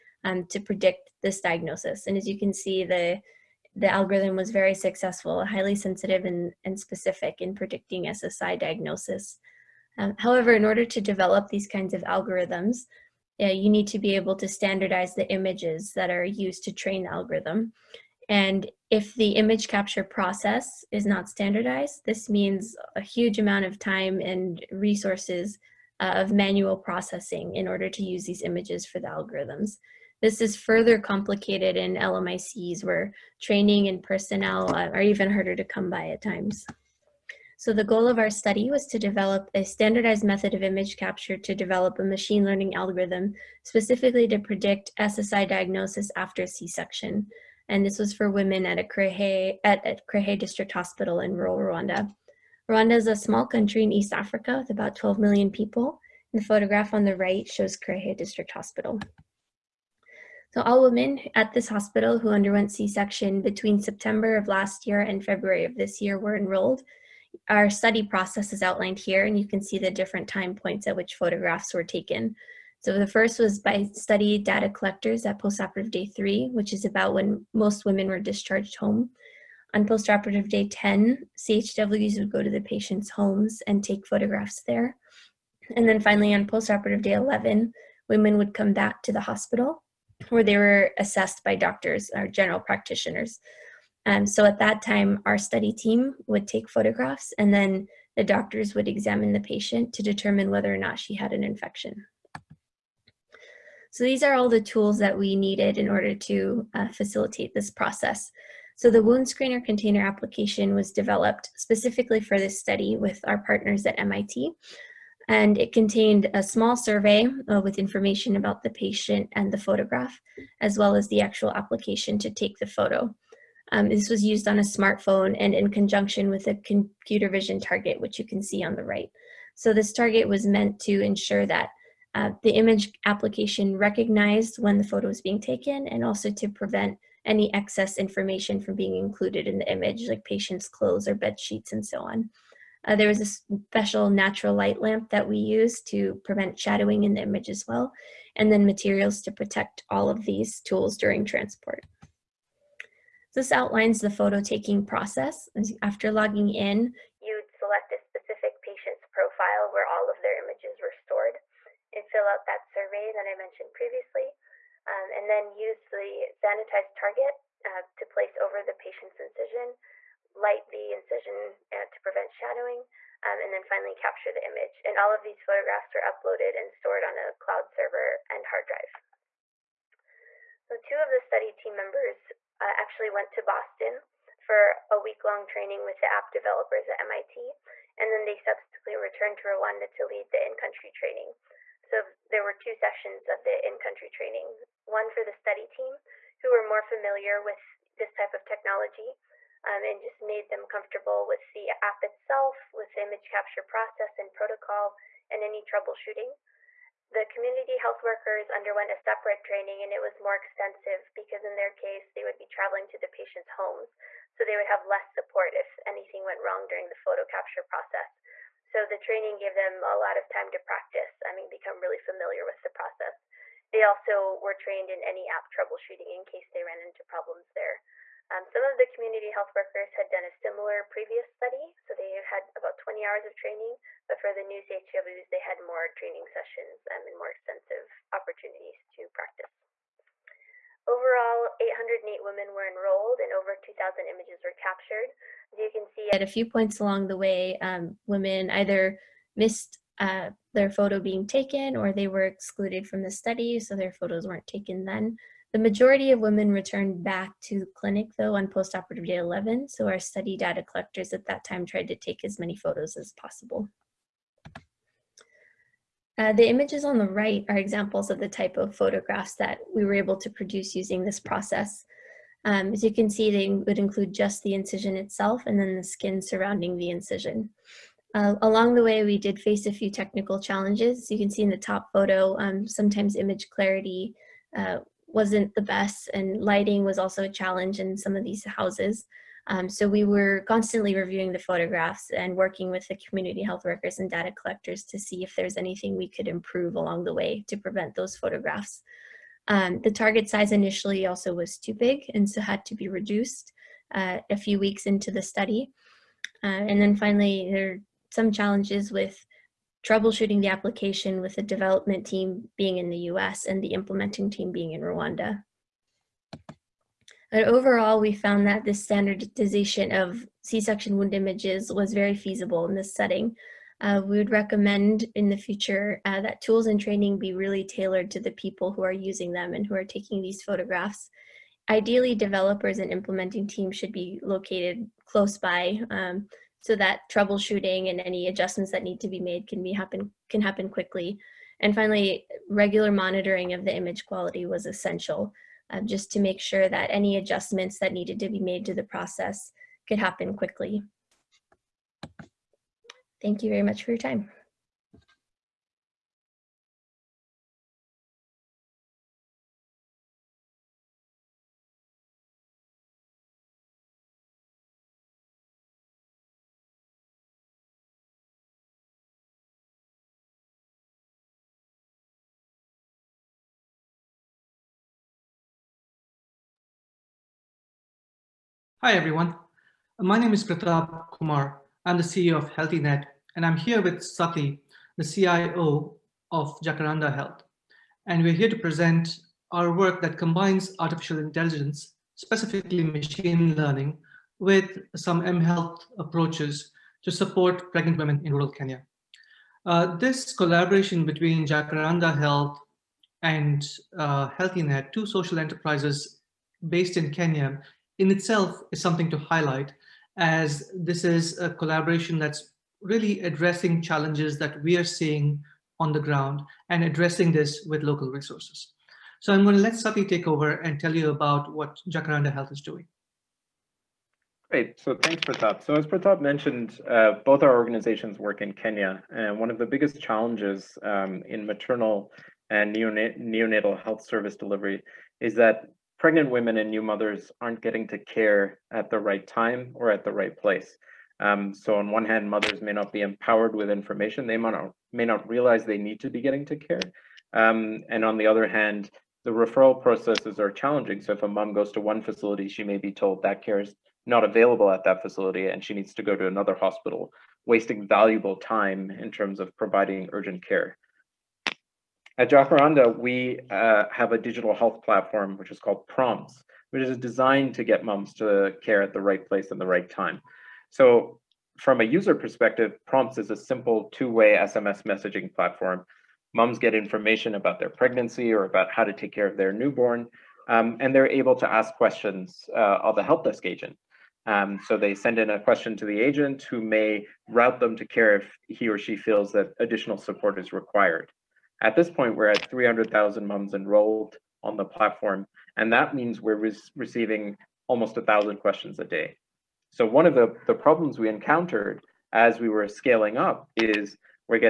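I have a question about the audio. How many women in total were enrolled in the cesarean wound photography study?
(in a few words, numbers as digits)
808.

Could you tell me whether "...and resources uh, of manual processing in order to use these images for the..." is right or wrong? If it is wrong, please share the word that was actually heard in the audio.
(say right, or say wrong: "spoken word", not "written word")
right.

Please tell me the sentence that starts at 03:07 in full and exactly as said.
And then they subsequently returned to Rwanda to lead the in country training.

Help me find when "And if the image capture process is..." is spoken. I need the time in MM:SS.
00:18.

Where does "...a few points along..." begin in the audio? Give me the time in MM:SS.
04:06.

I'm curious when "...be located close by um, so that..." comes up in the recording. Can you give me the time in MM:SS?
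05:33.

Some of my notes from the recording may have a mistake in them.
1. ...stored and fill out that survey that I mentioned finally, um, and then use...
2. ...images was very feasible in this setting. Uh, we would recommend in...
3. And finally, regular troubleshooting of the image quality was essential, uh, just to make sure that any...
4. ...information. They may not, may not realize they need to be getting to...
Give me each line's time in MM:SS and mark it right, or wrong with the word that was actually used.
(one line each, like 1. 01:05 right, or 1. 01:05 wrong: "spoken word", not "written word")
1. 02:40 wrong: "previously", not "finally"
2. 05:21 right
3. 05:41 wrong: "monitoring", not "troubleshooting"
4. 07:23 right.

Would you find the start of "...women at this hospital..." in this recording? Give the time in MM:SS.
01:00.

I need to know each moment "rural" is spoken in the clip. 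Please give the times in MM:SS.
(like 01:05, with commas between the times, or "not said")
00:51, 06:38.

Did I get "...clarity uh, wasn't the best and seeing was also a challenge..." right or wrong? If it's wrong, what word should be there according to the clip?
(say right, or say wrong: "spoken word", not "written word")
wrong: "lighting", not "seeing".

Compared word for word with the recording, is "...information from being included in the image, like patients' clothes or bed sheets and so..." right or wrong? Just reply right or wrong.
right.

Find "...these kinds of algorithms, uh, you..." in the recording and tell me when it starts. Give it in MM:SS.
00:11.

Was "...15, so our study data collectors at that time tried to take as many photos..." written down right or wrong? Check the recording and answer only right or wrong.
wrong.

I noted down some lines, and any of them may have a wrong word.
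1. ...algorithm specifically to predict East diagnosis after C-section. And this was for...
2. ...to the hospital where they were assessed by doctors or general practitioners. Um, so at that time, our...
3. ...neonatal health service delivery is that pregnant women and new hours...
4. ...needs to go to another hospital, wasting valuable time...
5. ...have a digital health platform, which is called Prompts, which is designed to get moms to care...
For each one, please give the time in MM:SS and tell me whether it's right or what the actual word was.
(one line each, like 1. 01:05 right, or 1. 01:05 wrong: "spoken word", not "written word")
1. 00:42 wrong: "SSI", not "East"
2. 01:29 right
3. 07:12 wrong: "mothers", not "hours"
4. 07:35 right
5. 07:43 right.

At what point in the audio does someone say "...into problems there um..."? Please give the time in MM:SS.
03:46.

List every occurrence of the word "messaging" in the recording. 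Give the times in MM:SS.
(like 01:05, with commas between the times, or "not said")
07:54.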